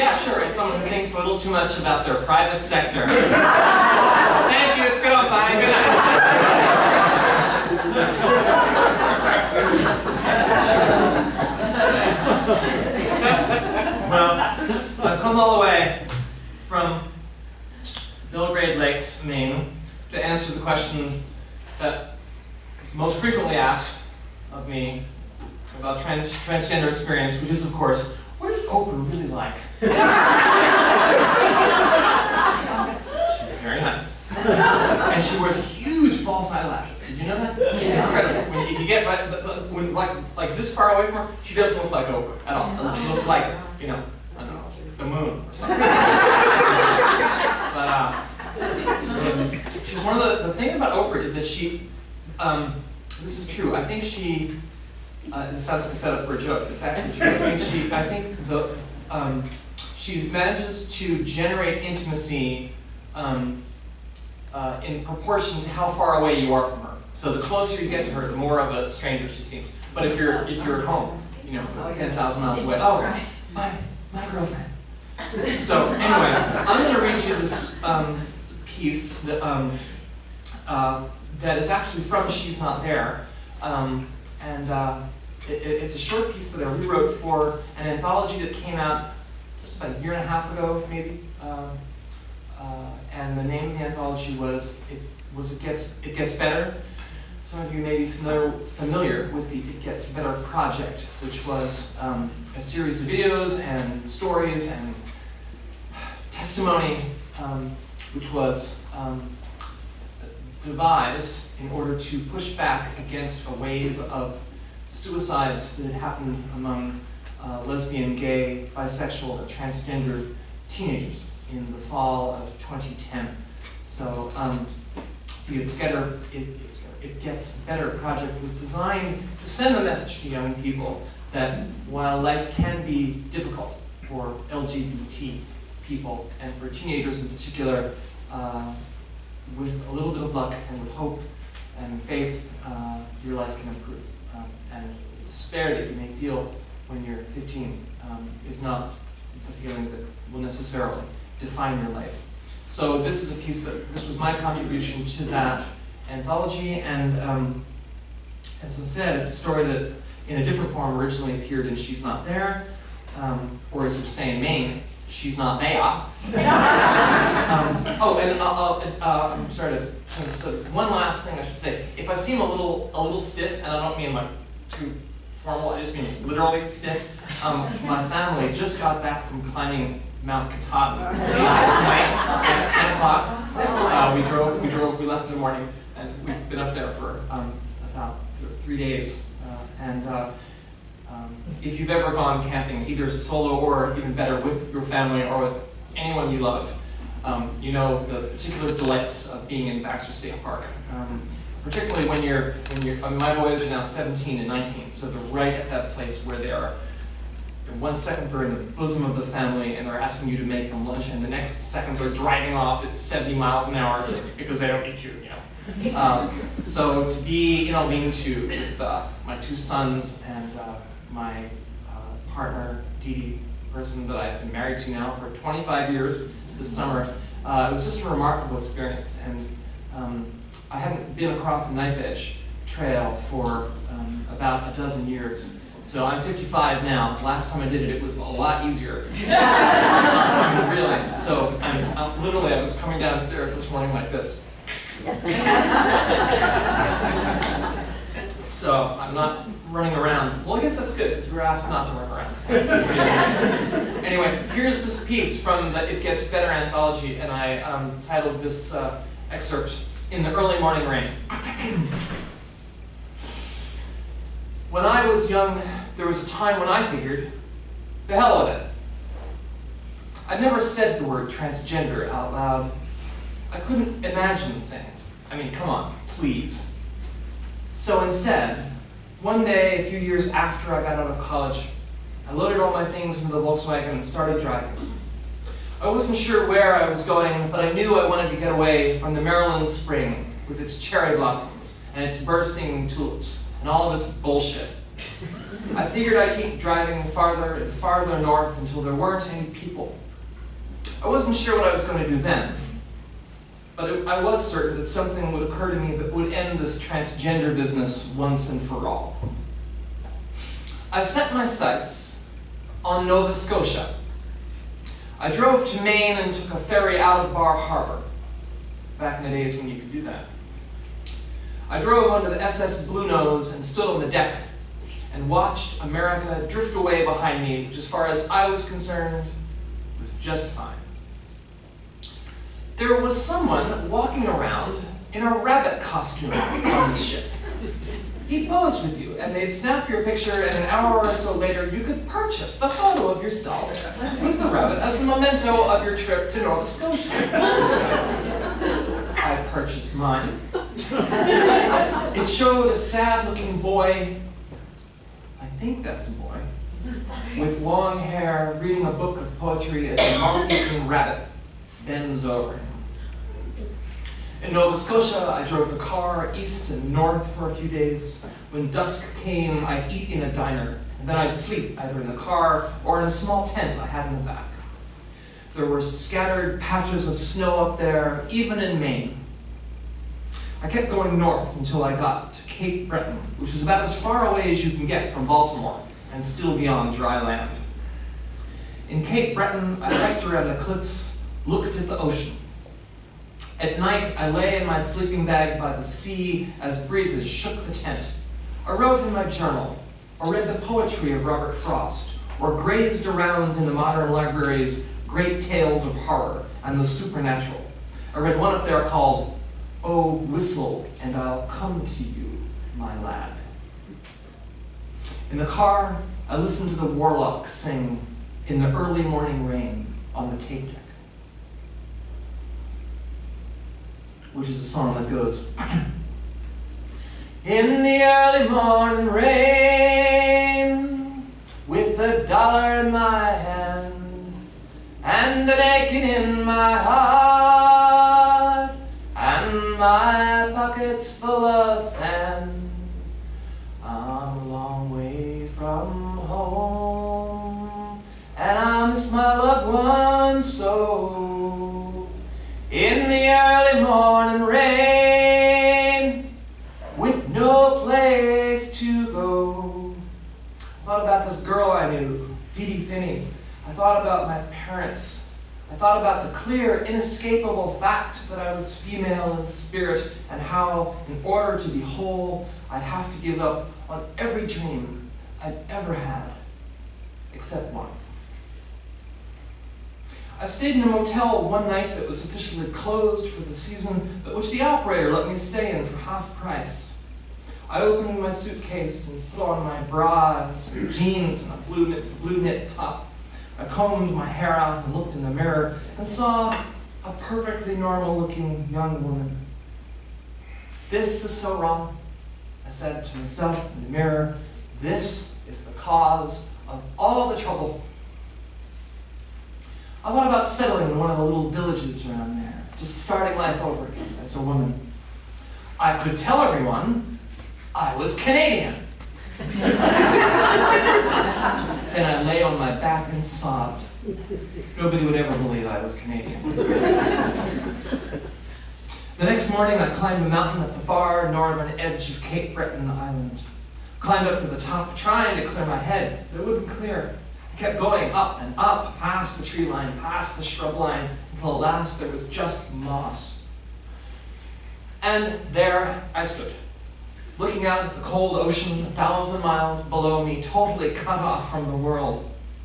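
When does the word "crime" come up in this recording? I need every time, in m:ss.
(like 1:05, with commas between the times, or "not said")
not said.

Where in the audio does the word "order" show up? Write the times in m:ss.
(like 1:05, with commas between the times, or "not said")
1:51, 7:51.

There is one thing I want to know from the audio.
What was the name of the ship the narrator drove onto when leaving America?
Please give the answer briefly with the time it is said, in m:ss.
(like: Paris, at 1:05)
SS Bluenose, at 5:22.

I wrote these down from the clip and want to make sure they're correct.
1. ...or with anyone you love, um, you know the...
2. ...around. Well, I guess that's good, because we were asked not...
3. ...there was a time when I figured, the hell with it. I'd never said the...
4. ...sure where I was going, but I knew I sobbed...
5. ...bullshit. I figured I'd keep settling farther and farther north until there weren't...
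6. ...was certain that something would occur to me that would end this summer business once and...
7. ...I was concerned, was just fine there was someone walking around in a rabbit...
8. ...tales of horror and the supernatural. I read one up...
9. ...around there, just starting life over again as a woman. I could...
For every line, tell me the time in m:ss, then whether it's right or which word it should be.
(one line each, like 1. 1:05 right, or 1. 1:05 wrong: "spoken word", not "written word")
1. 3:15 right
2. 4:09 right
3. 4:25 right
4. 4:46 wrong: "wanted", not "sobbed"
5. 4:54 wrong: "driving", not "settling"
6. 5:04 wrong: "transgender", not "summer"
7. 5:28 right
8. 6:45 right
9. 8:32 right.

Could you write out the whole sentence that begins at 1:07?
So the closer you get to her, the more of a stranger she seems.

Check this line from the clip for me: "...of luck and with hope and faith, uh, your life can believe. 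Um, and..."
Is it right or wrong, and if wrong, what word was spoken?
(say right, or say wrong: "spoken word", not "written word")
wrong: "improve", not "believe".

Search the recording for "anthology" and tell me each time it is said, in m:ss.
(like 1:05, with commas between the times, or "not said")
1:27, 1:33, 2:36, 4:16.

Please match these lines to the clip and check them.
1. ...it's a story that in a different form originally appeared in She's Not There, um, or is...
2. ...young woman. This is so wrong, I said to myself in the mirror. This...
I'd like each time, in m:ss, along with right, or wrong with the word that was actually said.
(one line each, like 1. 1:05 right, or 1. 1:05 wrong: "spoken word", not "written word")
1. 2:39 right
2. 8:18 right.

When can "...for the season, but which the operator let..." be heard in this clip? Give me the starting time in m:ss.
8:03.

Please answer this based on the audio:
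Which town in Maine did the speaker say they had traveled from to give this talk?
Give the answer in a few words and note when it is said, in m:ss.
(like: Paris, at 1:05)
Belgrade Lakes, at 0:18.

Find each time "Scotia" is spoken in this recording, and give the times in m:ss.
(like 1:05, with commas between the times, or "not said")
5:13, 5:46, 6:04.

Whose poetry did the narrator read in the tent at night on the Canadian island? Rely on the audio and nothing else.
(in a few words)
Robert Frost.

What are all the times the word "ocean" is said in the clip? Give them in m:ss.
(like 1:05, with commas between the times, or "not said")
6:31, 9:08.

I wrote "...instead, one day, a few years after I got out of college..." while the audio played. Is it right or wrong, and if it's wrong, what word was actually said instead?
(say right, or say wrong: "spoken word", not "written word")
right.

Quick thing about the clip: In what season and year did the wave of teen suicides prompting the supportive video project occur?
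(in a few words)
Fall of 2010.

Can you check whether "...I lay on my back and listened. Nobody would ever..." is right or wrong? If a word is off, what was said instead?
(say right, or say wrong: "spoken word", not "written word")
wrong: "sobbed", not "listened".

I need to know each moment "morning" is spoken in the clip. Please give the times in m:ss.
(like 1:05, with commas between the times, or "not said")
3:05, 4:03, 4:20, 6:59, 7:08, 7:33, 8:49.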